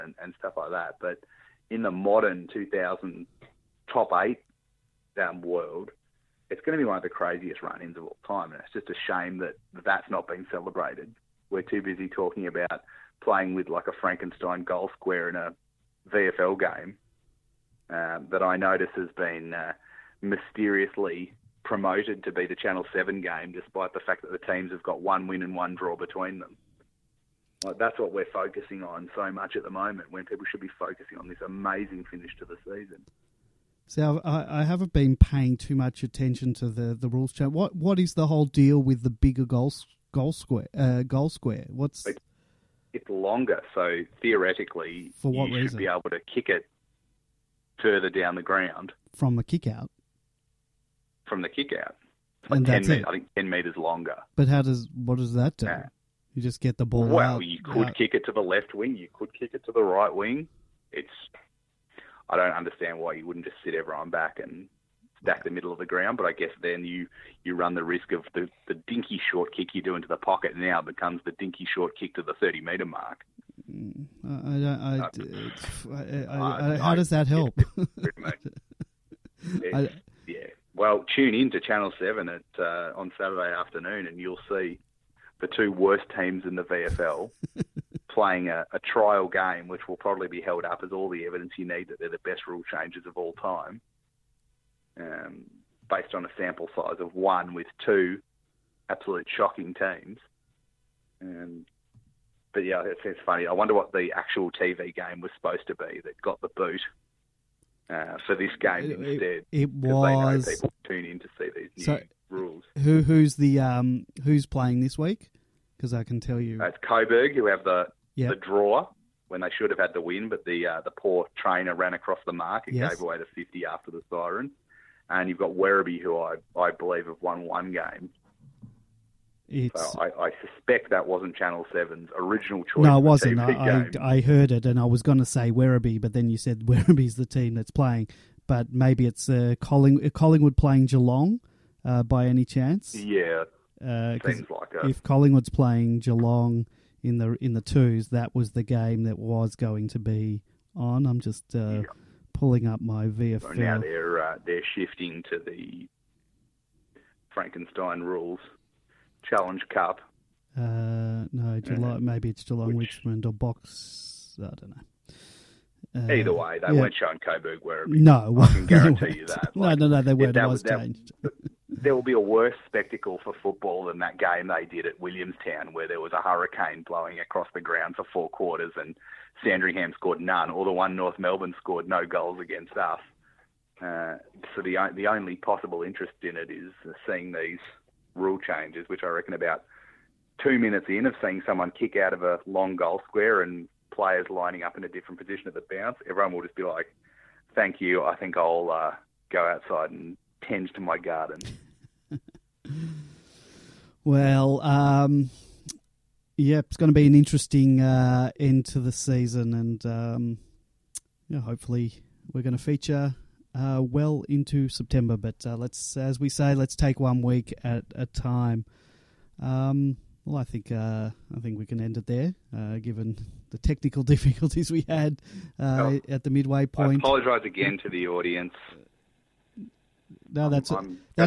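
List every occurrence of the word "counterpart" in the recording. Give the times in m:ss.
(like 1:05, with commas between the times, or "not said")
not said.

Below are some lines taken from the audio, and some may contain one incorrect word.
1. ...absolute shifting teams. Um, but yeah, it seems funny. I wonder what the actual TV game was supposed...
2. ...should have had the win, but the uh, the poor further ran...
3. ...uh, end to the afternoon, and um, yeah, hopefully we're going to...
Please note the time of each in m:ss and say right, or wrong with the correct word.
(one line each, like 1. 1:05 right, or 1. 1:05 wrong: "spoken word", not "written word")
1. 1:38 wrong: "shocking", not "shifting"
2. 1:59 wrong: "trainer", not "further"
3. 3:27 wrong: "season", not "afternoon".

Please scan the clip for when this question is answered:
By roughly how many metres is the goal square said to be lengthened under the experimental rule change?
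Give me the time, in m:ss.
0:53.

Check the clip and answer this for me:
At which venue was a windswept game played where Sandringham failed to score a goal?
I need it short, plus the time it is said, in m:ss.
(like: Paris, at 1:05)
Williamstown, at 2:54.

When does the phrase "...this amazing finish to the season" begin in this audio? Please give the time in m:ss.
0:31.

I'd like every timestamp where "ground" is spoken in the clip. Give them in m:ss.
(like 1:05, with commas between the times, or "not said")
0:48, 1:05, 2:57.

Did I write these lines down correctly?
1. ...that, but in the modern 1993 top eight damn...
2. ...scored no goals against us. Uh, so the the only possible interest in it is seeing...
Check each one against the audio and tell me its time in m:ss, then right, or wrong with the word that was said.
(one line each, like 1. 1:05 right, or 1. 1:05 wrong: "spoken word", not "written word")
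1. 0:00 wrong: "2000", not "1993"
2. 3:01 right.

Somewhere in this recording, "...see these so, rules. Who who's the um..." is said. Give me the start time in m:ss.
1:51.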